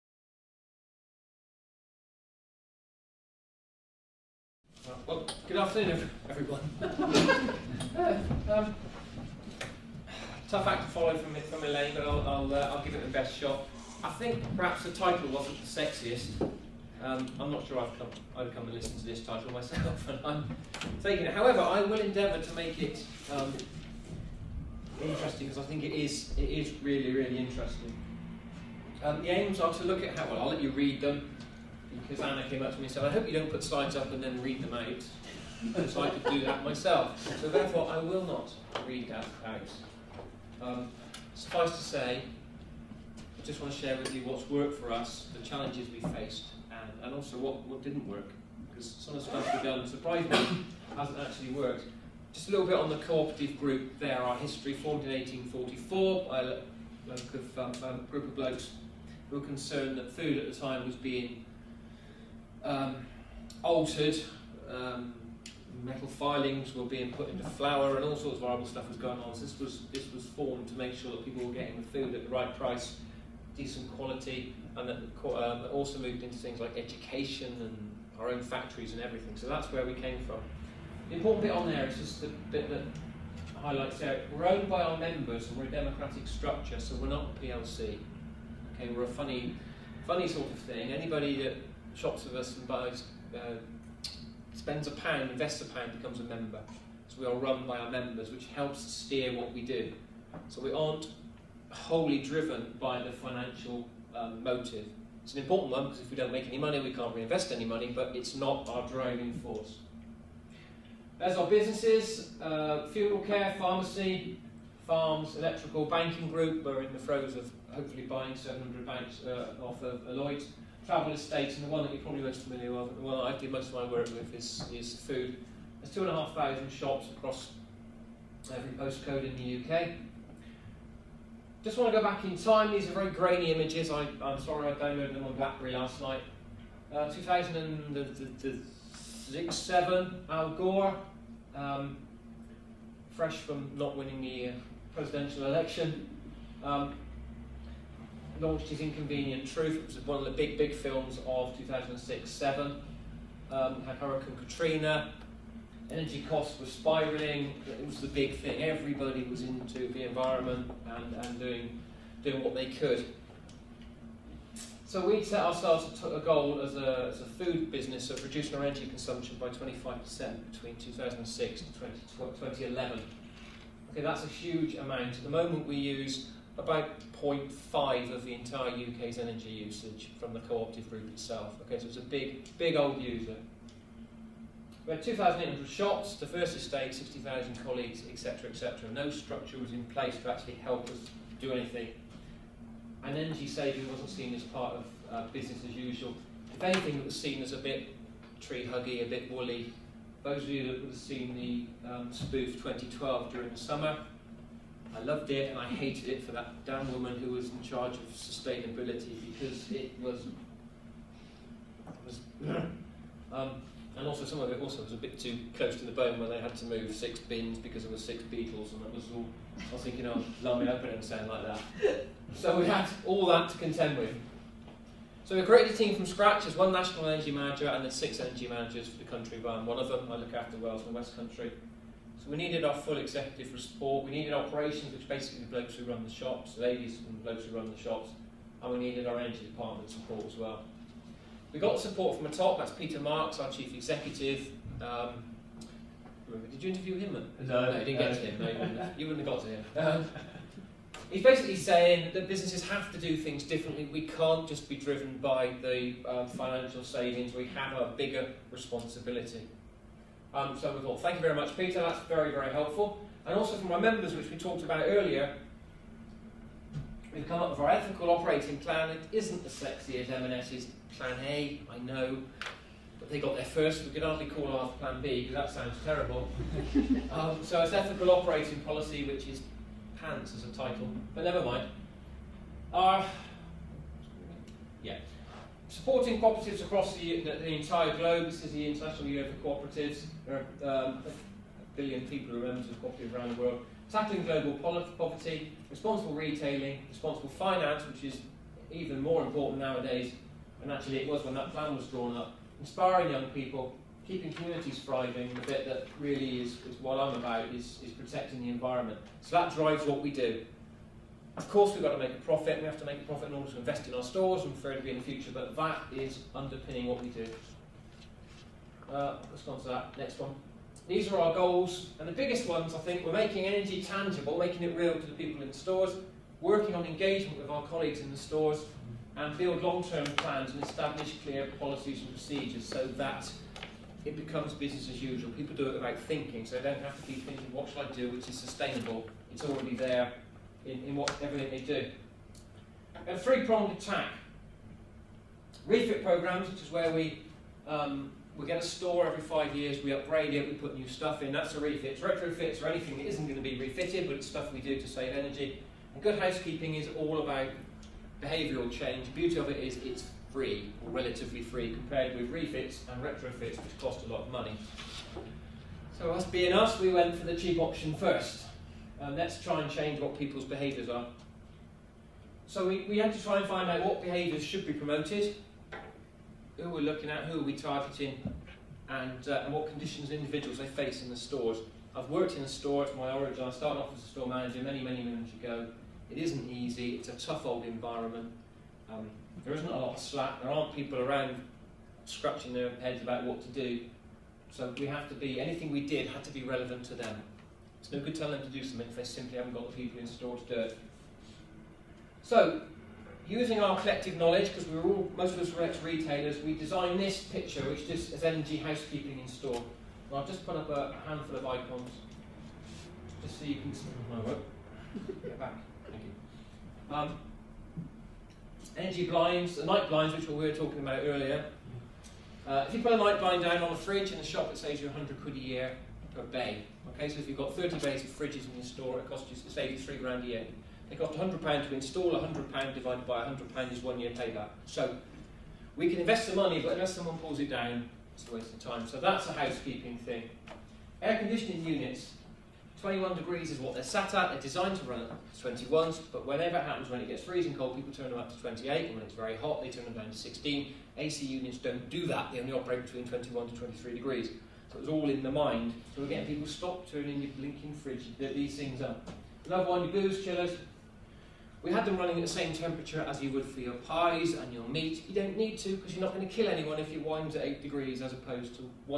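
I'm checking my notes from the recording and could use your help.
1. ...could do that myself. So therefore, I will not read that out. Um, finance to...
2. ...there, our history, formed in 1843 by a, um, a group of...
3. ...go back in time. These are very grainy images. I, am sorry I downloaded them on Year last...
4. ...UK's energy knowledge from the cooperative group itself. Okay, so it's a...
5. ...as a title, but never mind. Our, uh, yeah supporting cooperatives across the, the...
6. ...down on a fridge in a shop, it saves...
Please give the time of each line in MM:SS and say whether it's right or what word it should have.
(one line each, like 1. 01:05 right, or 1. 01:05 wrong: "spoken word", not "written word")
1. 00:36 wrong: "suffice", not "finance"
2. 00:53 wrong: "1844", not "1843"
3. 02:11 wrong: "BlackBerry", not "Year"
4. 02:58 wrong: "usage", not "knowledge"
5. 04:40 right
6. 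07:03 right.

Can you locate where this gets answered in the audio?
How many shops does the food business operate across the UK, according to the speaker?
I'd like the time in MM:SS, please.
02:05.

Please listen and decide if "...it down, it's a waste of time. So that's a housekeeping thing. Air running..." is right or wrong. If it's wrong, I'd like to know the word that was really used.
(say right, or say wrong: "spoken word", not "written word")
wrong: "conditioning", not "running".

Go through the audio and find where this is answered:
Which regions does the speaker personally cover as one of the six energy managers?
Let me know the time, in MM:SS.
03:50.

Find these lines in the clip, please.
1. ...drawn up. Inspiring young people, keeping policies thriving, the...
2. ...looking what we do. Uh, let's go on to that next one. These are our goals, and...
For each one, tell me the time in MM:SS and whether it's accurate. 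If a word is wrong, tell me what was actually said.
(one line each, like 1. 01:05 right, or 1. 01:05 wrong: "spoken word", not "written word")
1. 05:01 wrong: "communities", not "policies"
2. 05:16 wrong: "underpinning", not "looking".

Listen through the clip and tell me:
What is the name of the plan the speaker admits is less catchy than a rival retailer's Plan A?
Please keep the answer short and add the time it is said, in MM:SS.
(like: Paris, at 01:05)
ethical operating plan, at 04:27.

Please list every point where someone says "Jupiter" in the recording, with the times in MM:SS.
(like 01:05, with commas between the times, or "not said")
not said.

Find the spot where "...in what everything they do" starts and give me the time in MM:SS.
05:40.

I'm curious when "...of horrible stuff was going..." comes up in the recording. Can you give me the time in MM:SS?
01:08.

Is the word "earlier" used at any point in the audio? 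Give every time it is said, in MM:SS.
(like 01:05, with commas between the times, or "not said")
04:24, 07:01.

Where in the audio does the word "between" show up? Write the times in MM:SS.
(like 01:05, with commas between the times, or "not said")
02:50, 07:32.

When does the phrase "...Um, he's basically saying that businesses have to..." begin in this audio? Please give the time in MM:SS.
04:10.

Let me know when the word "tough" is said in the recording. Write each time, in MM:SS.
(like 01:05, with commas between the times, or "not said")
00:10, 06:27.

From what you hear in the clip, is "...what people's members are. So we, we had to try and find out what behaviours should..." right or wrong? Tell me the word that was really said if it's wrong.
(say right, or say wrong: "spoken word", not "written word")
wrong: "behaviours", not "members".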